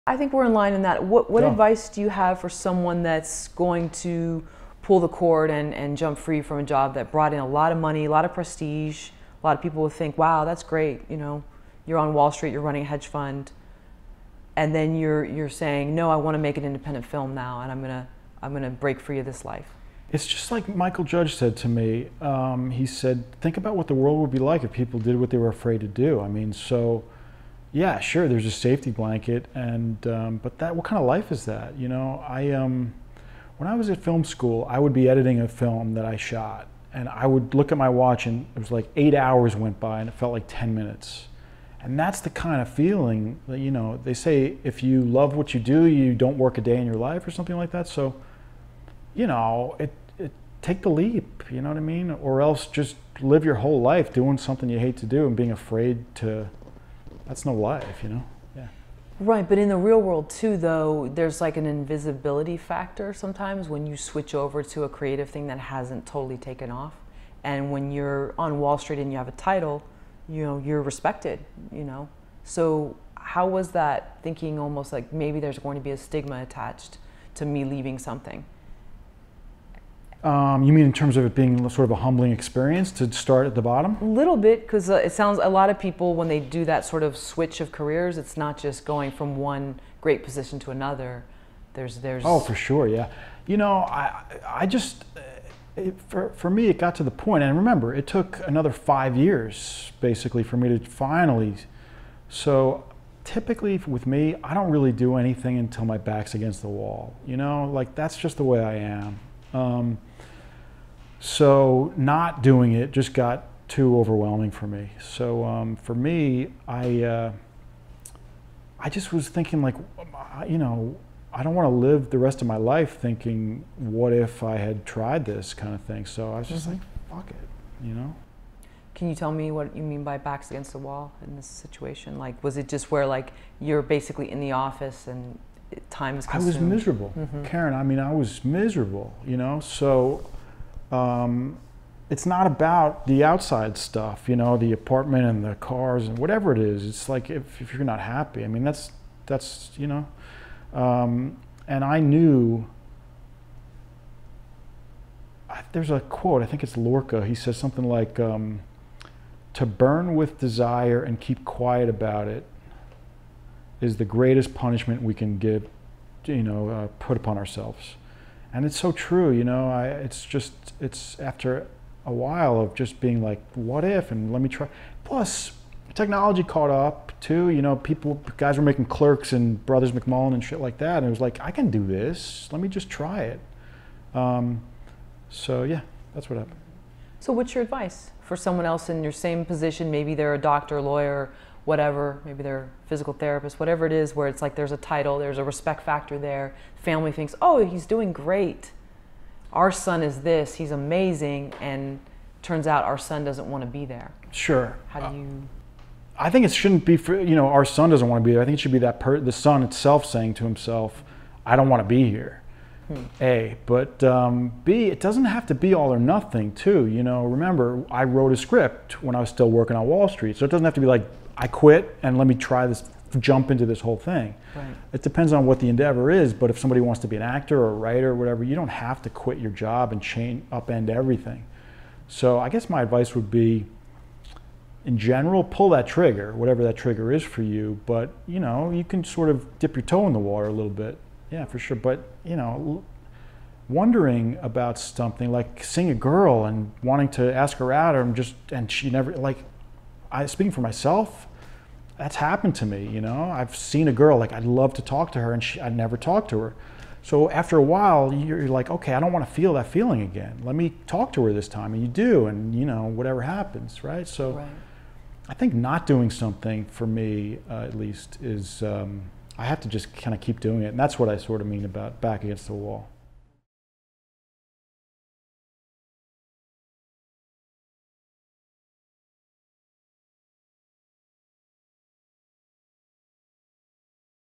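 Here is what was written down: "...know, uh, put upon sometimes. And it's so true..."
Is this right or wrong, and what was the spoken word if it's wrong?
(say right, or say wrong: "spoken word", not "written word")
wrong: "ourselves", not "sometimes".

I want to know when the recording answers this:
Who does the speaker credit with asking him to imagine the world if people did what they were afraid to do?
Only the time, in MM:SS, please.
00:20.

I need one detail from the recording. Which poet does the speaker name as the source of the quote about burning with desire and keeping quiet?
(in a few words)
Lorca.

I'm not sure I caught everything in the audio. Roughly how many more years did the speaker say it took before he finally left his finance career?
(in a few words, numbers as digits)
5.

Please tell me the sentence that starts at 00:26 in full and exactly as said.
I mean, so yeah, sure, there's a safety blanket, and um, but that what kind of life is that?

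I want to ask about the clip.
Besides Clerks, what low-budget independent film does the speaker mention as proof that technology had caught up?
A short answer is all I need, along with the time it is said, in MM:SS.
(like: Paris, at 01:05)
Brothers McMullen, at 02:59.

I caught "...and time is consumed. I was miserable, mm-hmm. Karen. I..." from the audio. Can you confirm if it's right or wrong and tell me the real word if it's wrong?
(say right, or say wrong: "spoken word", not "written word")
right.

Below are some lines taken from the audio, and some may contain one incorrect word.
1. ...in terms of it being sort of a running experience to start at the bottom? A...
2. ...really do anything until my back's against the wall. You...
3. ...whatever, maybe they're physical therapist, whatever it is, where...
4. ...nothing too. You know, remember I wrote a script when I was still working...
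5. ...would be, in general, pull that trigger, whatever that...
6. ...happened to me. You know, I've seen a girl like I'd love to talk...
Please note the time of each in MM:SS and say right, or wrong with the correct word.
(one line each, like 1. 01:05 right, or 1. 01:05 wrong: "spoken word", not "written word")
1. 01:20 wrong: "humbling", not "running"
2. 01:44 right
3. 03:11 right
4. 03:35 right
5. 03:53 right
6. 04:12 right.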